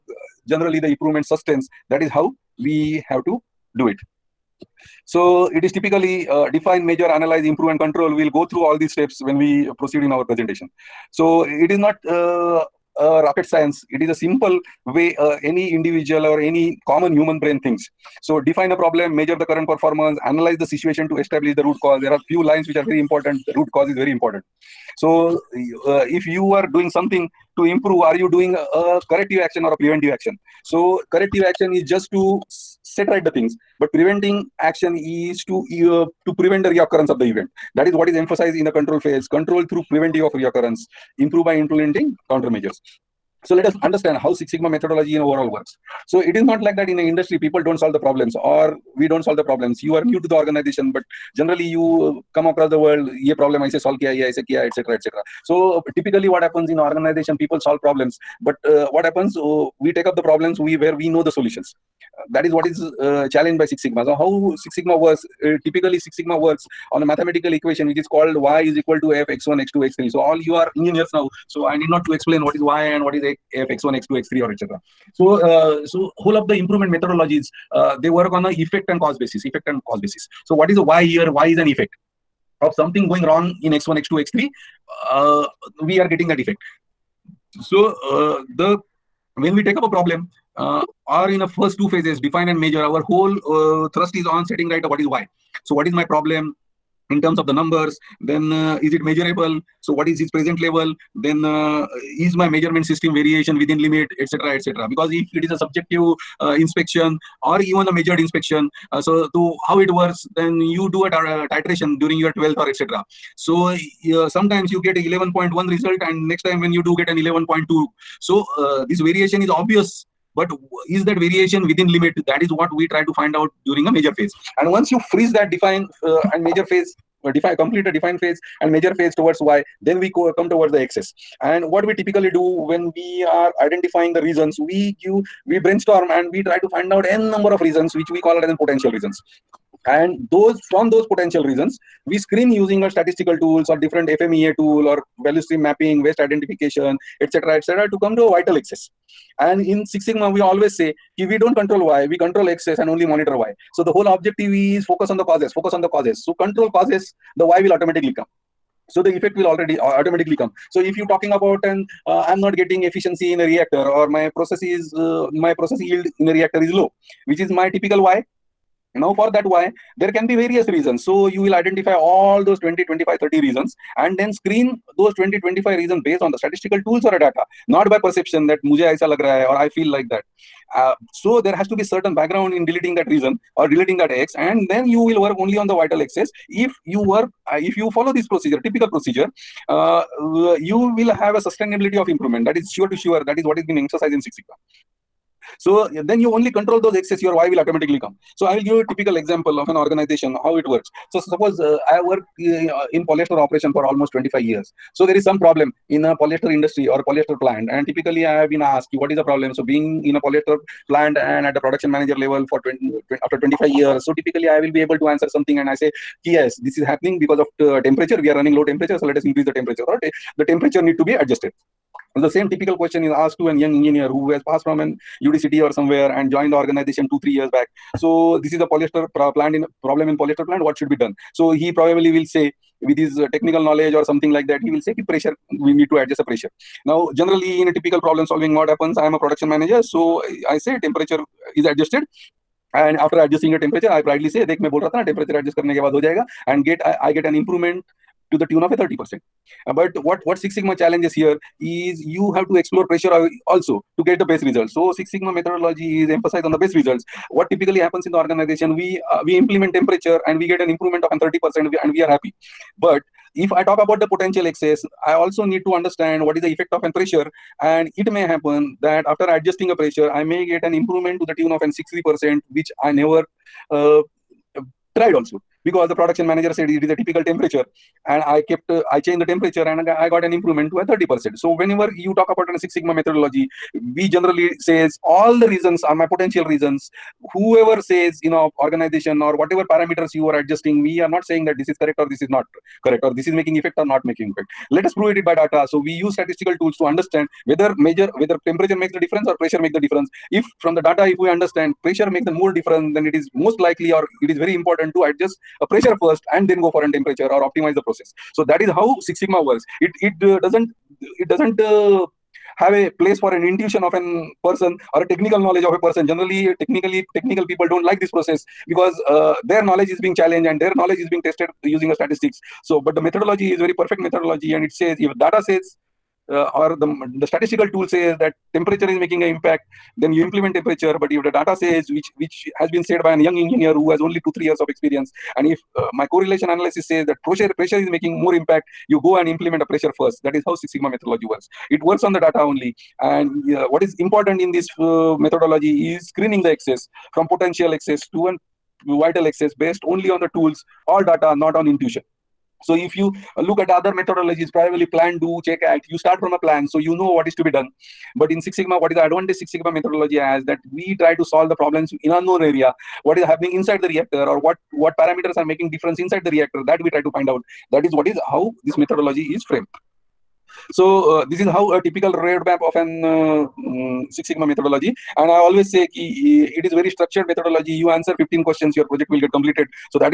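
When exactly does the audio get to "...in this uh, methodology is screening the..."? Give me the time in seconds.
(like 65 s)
344 s.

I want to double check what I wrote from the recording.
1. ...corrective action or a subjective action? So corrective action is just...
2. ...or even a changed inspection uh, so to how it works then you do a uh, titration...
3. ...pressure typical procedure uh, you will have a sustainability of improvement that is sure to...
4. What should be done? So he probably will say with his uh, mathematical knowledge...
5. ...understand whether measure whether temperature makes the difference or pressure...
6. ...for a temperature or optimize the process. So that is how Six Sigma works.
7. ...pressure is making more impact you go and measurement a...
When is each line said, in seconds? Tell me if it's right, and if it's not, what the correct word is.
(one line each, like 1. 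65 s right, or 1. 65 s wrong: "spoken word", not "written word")
1. 29 s wrong: "preventive", not "subjective"
2. 107 s wrong: "measured", not "changed"
3. 188 s wrong: "procedure", not "pressure"
4. 230 s wrong: "technical", not "mathematical"
5. 296 s right
6. 306 s right
7. 337 s wrong: "implement", not "measurement".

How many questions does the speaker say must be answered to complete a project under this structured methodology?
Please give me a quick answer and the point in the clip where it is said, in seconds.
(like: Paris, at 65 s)
15, at 378 s.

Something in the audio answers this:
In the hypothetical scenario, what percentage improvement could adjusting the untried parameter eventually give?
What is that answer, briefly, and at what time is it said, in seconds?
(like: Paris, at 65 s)
60%, at 271 s.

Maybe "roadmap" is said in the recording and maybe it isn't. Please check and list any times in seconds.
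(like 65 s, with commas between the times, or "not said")
372 s.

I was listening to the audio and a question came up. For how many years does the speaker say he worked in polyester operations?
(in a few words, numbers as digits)
25 years.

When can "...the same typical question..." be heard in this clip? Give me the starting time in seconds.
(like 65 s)
222 s.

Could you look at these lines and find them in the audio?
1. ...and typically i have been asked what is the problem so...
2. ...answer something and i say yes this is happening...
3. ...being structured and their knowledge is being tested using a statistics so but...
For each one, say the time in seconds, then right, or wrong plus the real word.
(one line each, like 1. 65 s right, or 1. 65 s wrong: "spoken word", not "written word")
1. 207 s right
2. 215 s right
3. 320 s wrong: "challenged", not "structured".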